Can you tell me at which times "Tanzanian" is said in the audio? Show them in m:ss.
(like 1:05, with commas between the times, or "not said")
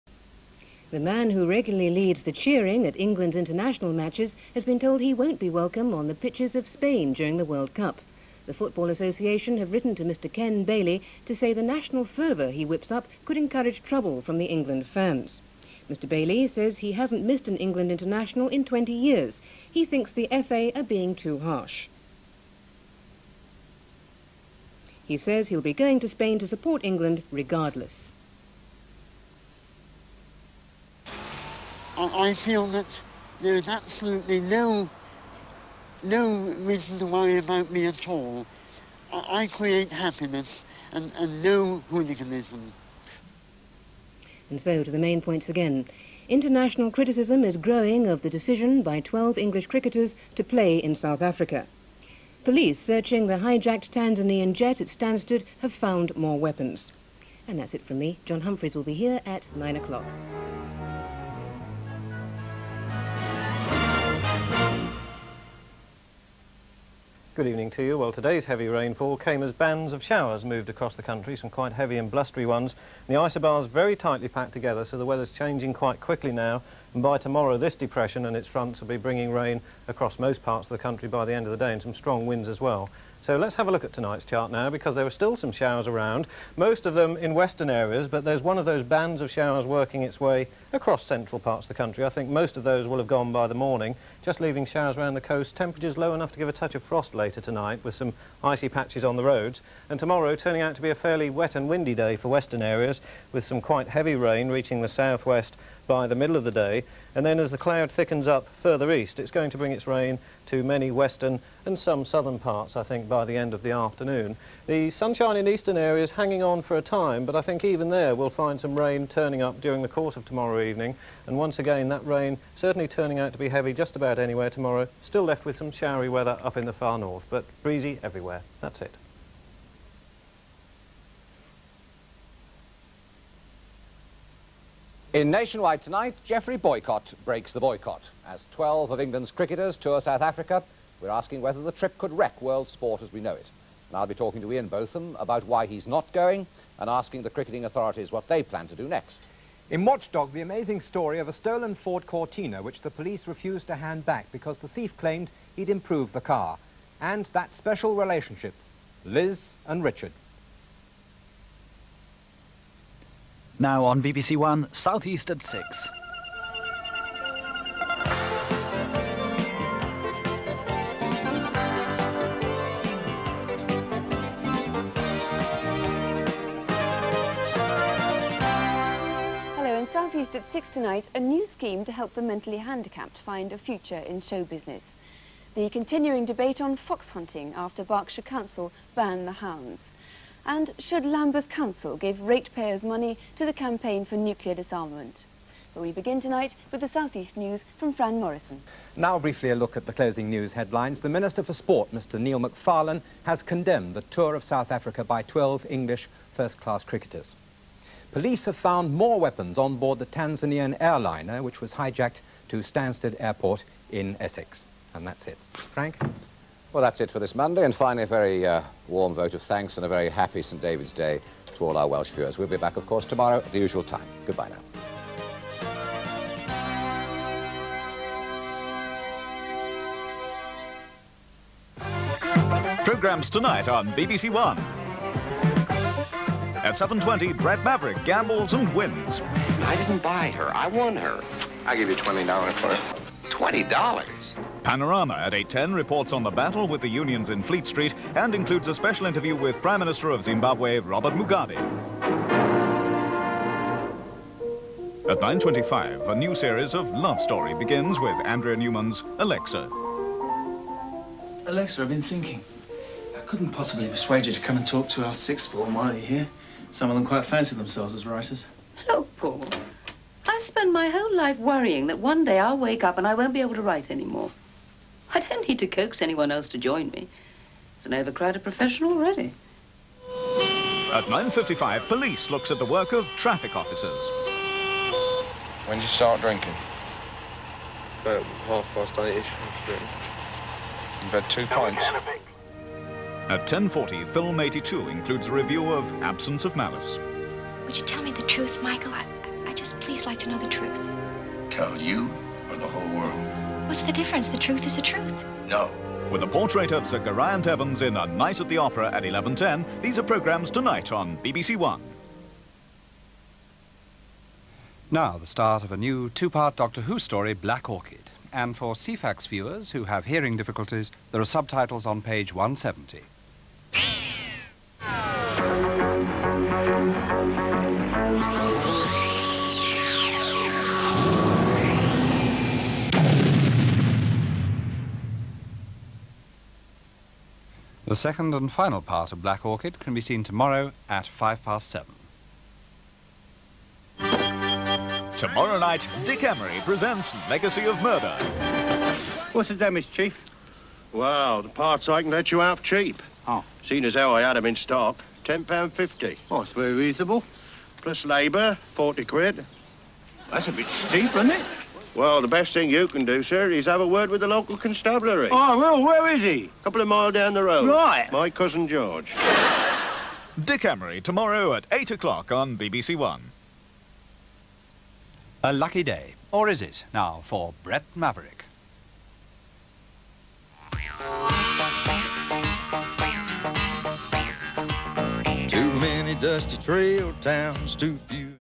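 0:53, 3:30.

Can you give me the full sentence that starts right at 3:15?
But we begin tonight with the Southeast News from Fran Morrison.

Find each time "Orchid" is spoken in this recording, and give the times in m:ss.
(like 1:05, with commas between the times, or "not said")
5:17, 5:39.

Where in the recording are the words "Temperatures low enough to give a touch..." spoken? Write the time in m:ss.
1:35.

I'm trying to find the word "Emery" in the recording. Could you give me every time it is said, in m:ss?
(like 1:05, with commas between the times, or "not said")
5:46, 6:10.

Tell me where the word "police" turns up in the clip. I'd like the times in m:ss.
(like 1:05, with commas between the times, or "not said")
0:52, 2:32, 3:28, 4:41.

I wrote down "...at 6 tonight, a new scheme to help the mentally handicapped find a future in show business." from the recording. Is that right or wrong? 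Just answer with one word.
right.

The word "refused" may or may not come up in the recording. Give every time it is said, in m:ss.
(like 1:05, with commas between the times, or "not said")
2:33.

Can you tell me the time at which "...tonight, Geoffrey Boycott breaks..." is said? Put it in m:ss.
2:15.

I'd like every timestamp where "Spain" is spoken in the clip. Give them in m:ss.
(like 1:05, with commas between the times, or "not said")
0:06, 0:26.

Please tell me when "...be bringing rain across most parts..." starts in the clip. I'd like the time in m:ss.
1:18.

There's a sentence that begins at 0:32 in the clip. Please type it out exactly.
I feel that there is absolutely no no reason to worry about me at all.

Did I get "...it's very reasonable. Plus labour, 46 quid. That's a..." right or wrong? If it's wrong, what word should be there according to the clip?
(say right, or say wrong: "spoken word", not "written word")
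wrong: "40", not "46".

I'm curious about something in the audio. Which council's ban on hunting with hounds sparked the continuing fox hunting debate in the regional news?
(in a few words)
Berkshire.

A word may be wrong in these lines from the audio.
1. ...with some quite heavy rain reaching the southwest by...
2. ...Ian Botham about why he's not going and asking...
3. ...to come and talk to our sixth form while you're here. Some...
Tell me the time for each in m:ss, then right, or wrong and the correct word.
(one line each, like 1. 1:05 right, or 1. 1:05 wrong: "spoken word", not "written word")
1. 1:43 right
2. 2:24 right
3. 4:24 right.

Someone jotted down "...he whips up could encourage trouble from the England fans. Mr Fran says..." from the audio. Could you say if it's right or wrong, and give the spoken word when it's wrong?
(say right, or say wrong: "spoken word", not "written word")
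wrong: "Bailey", not "Fran".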